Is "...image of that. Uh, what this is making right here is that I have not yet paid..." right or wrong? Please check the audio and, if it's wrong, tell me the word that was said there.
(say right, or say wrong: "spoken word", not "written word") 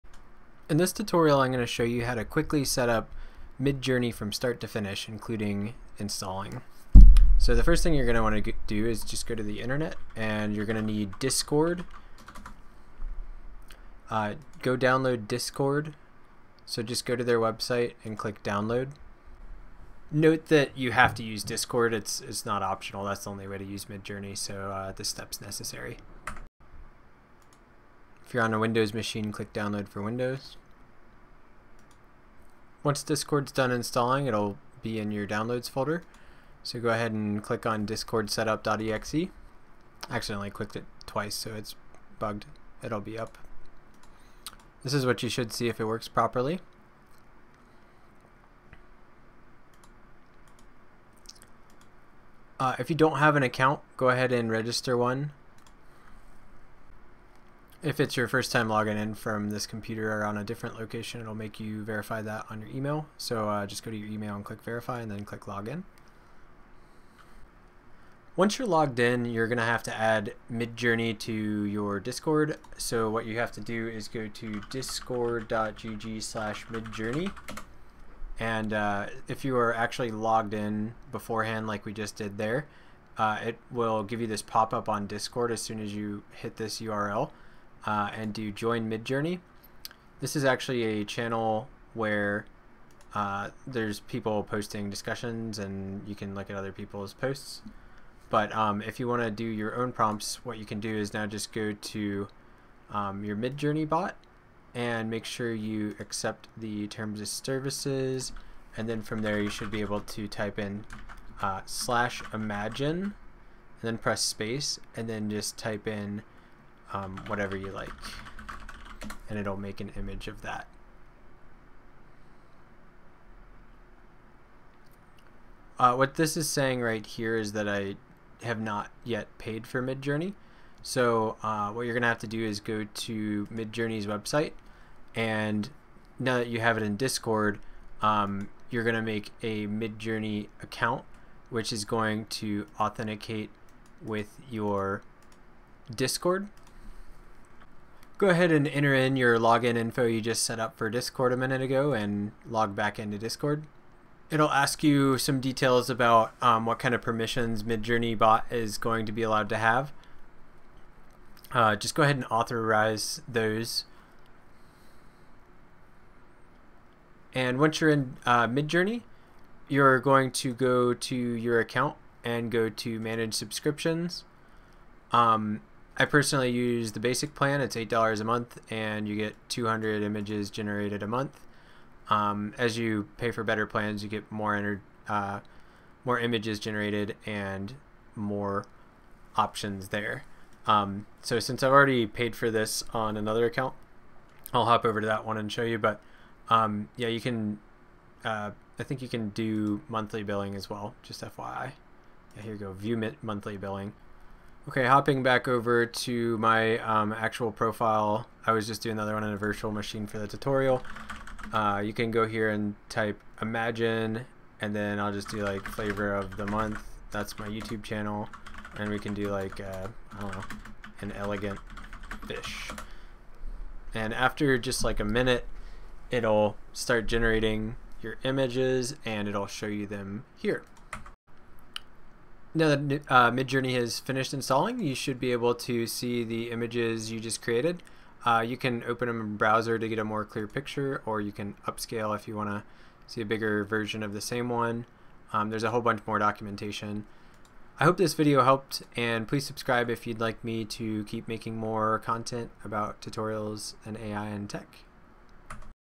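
wrong: "saying", not "making".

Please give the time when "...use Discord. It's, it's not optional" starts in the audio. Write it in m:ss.
0:21.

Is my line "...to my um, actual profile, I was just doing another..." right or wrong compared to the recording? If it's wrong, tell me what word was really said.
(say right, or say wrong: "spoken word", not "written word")
right.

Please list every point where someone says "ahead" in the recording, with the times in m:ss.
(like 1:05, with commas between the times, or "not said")
0:36, 0:54, 2:28, 2:42.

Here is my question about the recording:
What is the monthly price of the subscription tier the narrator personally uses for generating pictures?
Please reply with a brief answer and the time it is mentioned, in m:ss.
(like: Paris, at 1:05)
$8, at 2:57.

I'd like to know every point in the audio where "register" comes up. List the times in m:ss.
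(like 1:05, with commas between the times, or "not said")
0:54.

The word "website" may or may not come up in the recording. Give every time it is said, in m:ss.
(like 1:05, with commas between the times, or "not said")
0:17, 2:14.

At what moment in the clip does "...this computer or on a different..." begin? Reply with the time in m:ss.
0:59.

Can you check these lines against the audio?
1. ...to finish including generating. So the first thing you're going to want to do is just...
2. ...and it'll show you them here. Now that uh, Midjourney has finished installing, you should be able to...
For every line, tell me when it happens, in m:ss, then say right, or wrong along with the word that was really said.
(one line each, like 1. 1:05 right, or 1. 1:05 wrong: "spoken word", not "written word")
1. 0:04 wrong: "installing", not "generating"
2. 3:49 right.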